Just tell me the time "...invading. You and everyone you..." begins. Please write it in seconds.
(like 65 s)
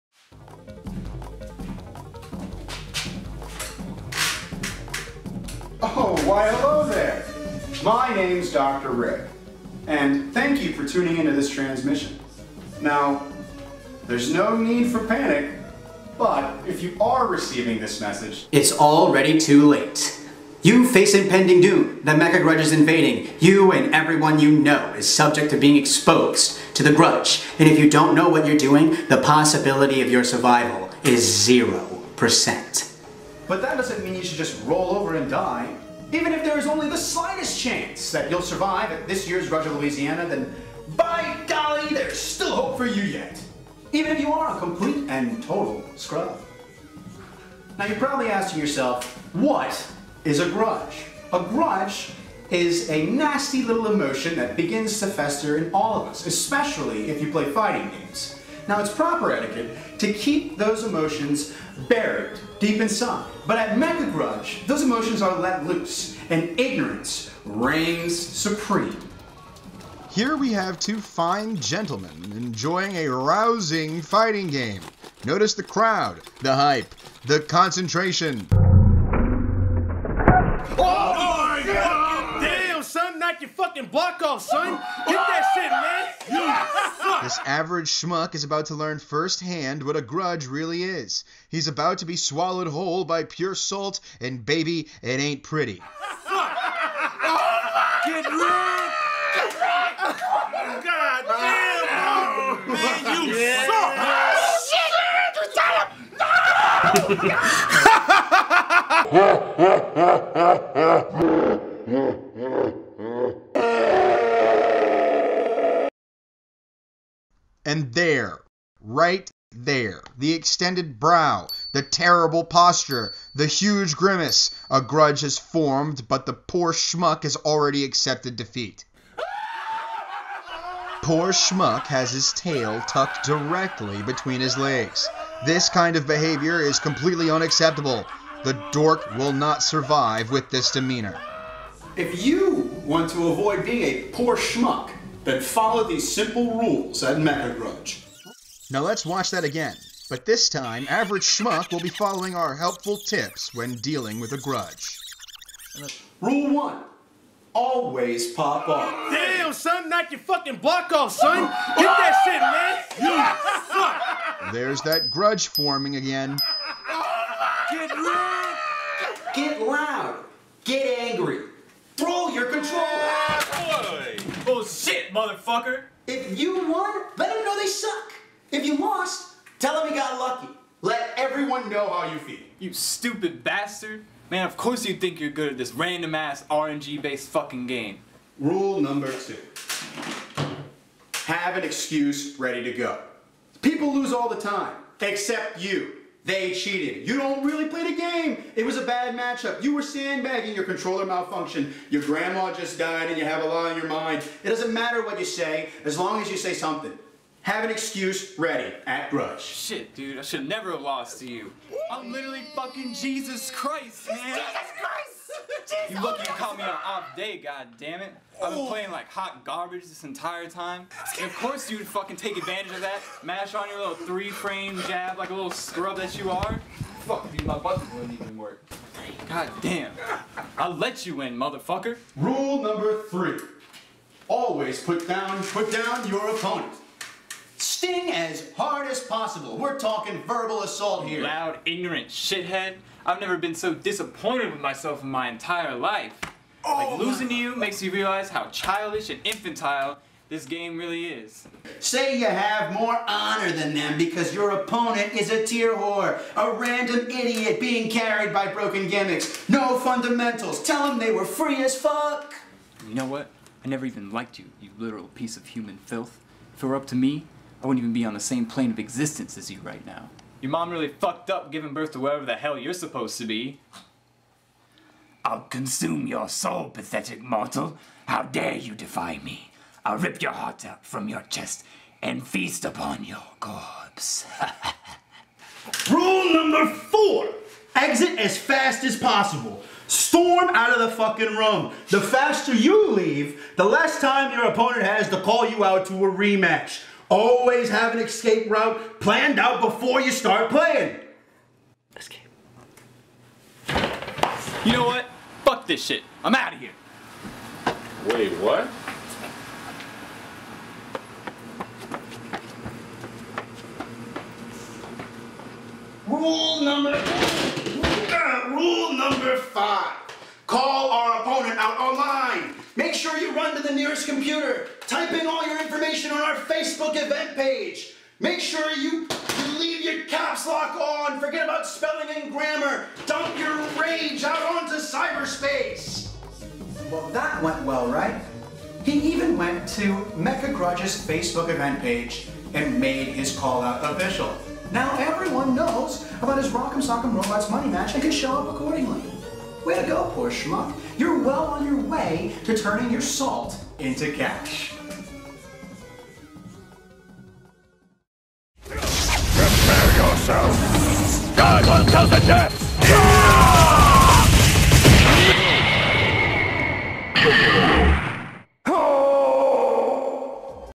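22 s.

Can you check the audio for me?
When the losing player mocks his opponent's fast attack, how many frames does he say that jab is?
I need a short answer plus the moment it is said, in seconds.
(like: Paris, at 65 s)
3, at 223 s.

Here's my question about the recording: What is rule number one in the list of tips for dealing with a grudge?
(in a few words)
Always pop off.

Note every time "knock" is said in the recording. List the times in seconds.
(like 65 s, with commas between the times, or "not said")
83 s, 159 s.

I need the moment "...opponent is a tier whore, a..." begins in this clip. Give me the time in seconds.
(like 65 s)
254 s.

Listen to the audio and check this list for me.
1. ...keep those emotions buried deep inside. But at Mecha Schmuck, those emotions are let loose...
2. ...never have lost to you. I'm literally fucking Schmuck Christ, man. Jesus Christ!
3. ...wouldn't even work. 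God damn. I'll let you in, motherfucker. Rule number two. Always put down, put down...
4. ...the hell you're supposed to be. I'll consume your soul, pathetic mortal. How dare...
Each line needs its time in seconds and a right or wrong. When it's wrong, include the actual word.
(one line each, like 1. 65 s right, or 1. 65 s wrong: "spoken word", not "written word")
1. 60 s wrong: "Grudge", not "Schmuck"
2. 210 s wrong: "Jesus", not "Schmuck"
3. 227 s wrong: "three", not "two"
4. 272 s right.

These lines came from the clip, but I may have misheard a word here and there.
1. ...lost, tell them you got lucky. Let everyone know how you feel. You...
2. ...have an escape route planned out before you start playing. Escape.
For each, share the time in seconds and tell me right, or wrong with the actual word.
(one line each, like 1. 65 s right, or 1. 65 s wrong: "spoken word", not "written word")
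1. 178 s right
2. 297 s right.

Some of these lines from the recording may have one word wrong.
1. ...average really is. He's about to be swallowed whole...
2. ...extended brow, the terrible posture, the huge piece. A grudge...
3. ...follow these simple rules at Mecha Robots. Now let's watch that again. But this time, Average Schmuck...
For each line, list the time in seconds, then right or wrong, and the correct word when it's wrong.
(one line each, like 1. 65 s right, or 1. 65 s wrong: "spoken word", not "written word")
1. 90 s wrong: "grudge", not "average"
2. 120 s wrong: "grimace", not "piece"
3. 145 s wrong: "Grudge", not "Robots".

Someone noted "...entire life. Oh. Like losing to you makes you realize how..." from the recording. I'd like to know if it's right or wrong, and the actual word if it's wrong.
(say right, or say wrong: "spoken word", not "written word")
right.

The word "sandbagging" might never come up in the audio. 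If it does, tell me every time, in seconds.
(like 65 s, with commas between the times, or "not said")
199 s.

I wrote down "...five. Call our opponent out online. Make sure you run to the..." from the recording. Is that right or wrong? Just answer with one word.
right.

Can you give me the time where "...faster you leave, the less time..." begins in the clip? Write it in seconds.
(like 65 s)
292 s.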